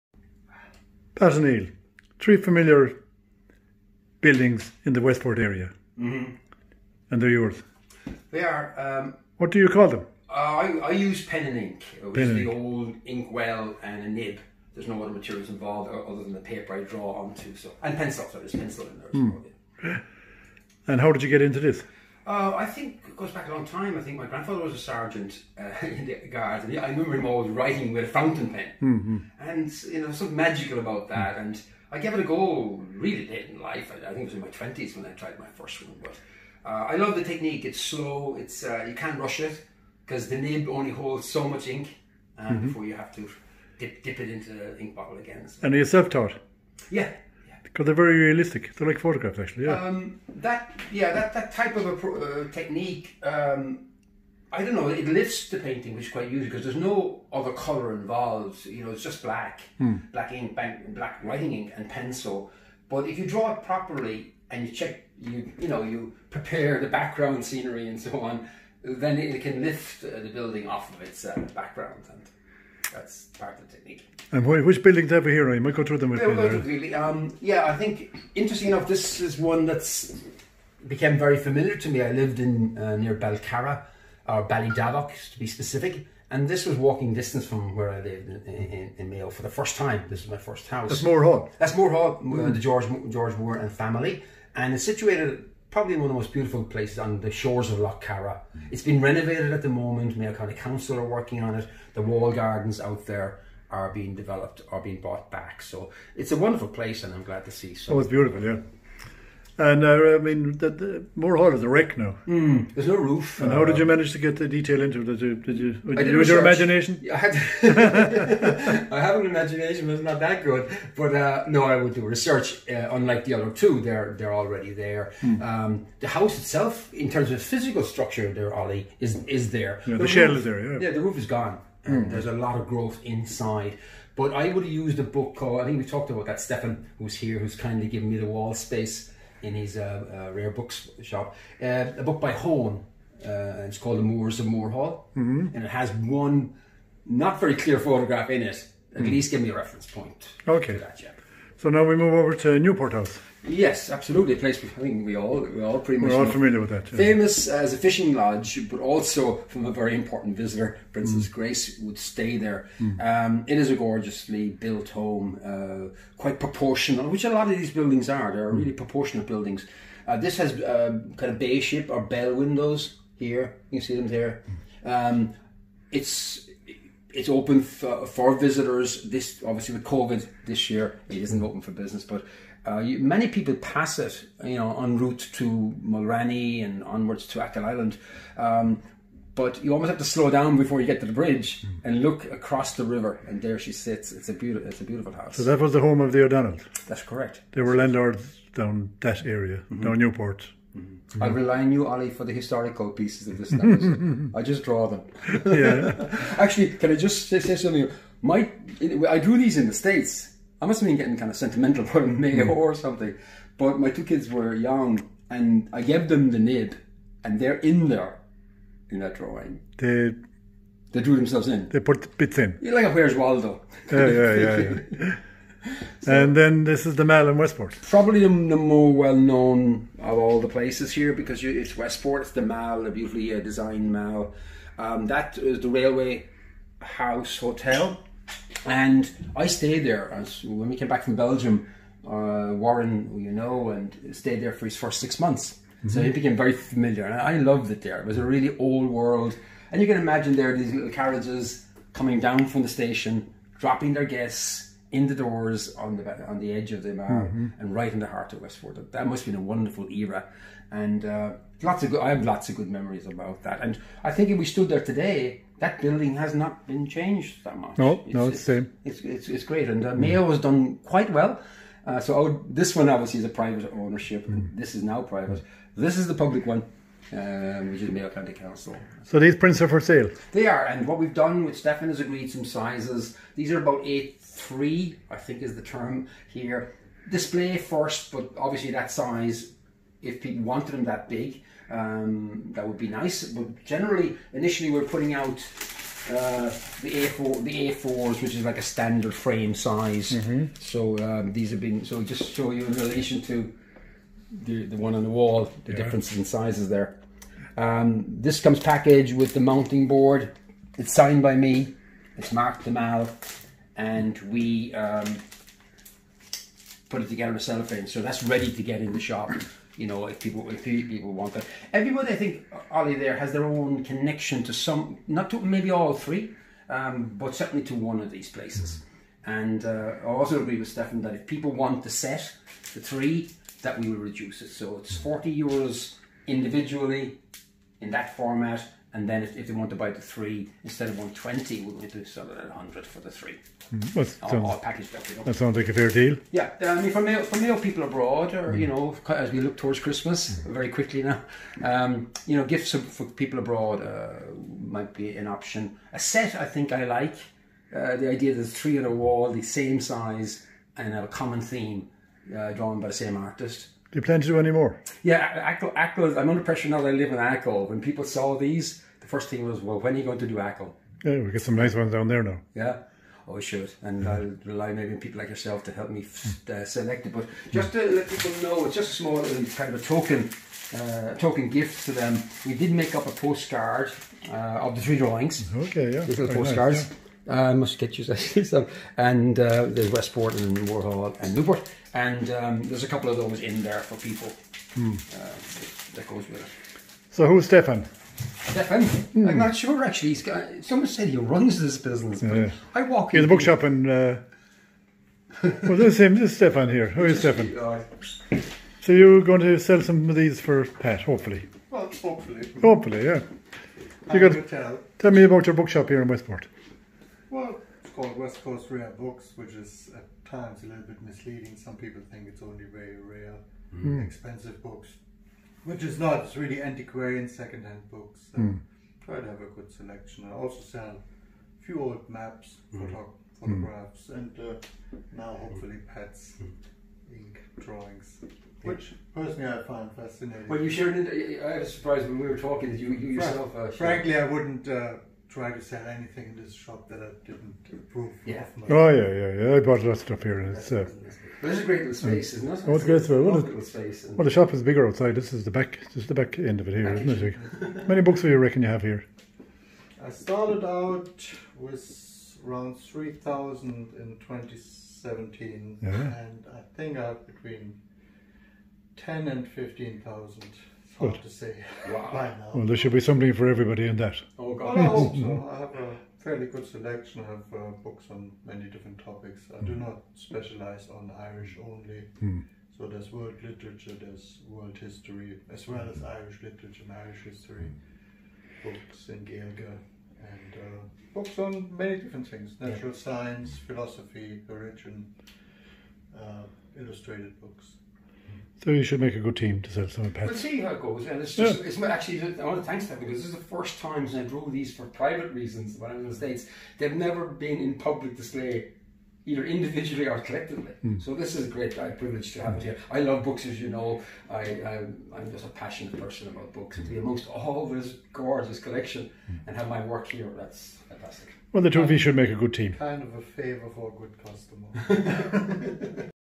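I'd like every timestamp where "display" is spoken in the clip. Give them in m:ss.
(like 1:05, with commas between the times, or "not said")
4:47, 8:28.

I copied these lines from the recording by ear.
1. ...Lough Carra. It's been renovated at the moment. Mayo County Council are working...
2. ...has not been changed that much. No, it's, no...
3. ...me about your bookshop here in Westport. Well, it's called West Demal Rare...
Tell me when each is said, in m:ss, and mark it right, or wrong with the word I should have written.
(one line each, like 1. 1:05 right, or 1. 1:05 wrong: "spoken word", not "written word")
1. 1:37 right
2. 4:26 right
3. 6:55 wrong: "Coast", not "Demal".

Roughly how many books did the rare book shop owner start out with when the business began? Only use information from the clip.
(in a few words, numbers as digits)
3,000.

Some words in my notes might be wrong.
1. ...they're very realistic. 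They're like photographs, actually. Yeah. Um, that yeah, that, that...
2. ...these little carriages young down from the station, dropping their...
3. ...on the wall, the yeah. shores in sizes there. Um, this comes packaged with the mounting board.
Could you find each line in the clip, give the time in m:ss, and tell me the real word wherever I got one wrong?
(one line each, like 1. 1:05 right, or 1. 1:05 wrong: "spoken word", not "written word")
1. 0:47 right
2. 4:10 wrong: "coming", not "young"
3. 5:04 wrong: "differences", not "shores".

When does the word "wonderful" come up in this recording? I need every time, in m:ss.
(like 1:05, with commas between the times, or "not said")
1:46, 4:19.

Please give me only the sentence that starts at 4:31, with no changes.
Uh, so would, this one obviously is a private ownership.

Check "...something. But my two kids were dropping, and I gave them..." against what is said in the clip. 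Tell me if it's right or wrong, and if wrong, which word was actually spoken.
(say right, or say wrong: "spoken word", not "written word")
wrong: "young", not "dropping".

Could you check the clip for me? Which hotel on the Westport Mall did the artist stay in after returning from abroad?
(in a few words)
Railway House Hotel.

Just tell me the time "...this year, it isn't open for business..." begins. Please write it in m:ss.
3:00.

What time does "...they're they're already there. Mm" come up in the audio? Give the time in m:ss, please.
2:03.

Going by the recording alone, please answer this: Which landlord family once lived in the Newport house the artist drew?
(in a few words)
The O'Donnells.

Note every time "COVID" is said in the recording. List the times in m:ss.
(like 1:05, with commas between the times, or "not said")
2:59.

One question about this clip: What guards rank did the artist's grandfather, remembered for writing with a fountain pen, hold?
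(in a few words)
Sergeant.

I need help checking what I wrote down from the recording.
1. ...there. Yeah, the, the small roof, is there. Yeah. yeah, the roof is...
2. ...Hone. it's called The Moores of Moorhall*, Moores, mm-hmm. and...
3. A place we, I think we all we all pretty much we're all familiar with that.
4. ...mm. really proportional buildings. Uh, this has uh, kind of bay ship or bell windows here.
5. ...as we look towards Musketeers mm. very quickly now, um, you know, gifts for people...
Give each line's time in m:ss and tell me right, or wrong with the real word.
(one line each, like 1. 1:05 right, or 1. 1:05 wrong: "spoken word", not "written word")
1. 2:09 wrong: "shell", not "small"
2. 2:22 wrong: "Hall", not "Moores"
3. 2:34 right
4. 2:48 right
5. 5:49 wrong: "Christmas", not "Musketeers".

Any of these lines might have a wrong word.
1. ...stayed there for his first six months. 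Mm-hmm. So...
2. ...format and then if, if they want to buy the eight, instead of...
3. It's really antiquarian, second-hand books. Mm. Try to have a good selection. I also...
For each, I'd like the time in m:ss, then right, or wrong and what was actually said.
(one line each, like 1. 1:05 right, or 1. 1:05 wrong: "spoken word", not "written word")
1. 4:04 right
2. 5:38 wrong: "three", not "eight"
3. 7:06 right.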